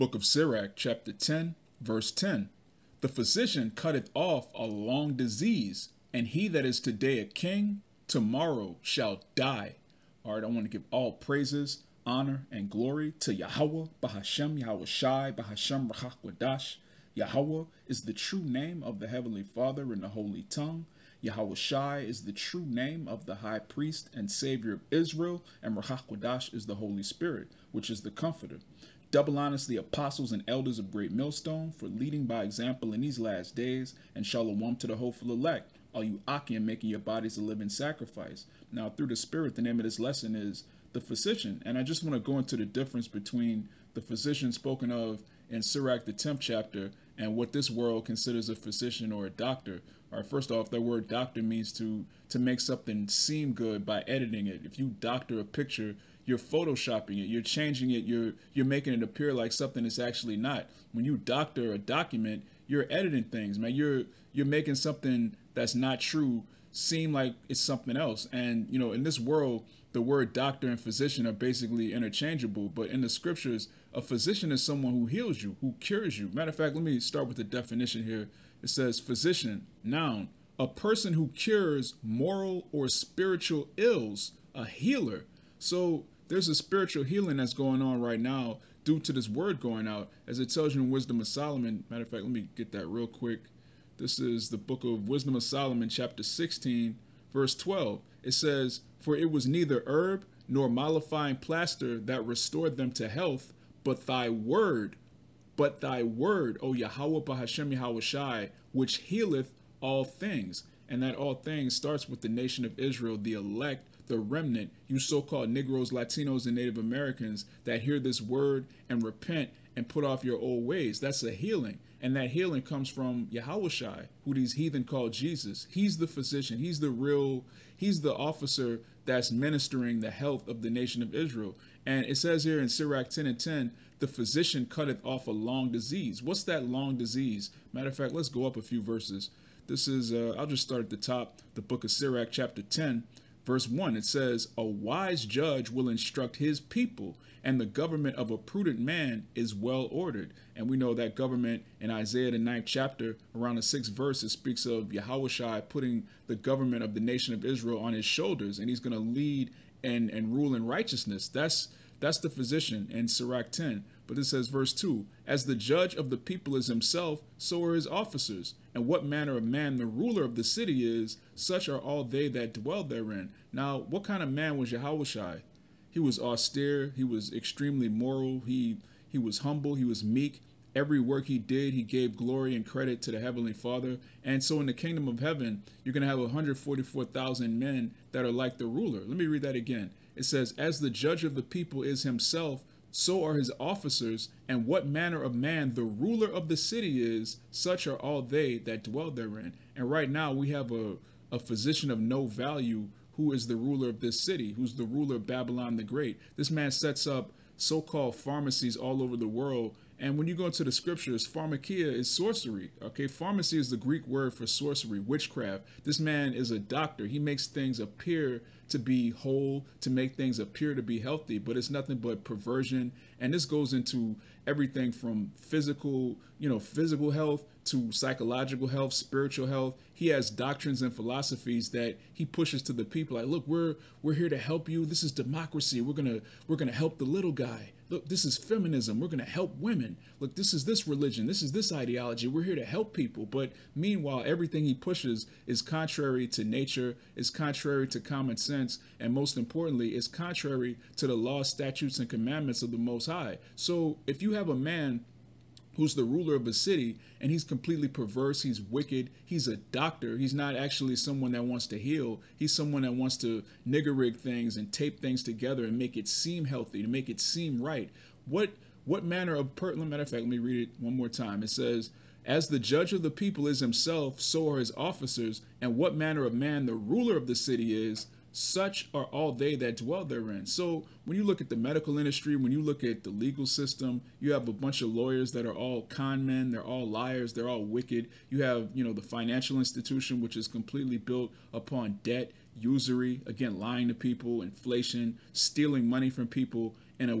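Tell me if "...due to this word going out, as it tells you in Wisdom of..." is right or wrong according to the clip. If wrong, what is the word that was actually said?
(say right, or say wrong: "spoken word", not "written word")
right.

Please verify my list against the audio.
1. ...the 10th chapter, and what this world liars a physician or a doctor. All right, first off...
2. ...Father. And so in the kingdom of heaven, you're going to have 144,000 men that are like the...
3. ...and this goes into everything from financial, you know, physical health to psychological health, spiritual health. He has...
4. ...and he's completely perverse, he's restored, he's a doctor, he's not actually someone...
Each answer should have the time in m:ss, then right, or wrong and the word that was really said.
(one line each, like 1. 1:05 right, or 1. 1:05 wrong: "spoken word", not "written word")
1. 0:46 wrong: "considers", not "liars"
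2. 3:03 right
3. 3:43 wrong: "physical", not "financial"
4. 4:17 wrong: "wicked", not "restored".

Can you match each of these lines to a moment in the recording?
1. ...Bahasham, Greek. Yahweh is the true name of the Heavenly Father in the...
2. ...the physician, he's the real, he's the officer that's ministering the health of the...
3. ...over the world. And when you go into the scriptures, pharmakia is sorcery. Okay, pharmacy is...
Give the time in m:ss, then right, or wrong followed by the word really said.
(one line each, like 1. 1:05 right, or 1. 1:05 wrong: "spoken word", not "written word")
1. 0:15 wrong: "Rahakwadash", not "Greek"
2. 2:05 right
3. 3:29 right.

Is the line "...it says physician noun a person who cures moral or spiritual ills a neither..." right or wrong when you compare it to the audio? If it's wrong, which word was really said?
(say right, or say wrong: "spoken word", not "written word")
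wrong: "healer", not "neither".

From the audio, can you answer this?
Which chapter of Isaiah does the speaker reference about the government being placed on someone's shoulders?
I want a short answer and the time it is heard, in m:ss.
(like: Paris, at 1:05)
Ninth chapter, at 2:32.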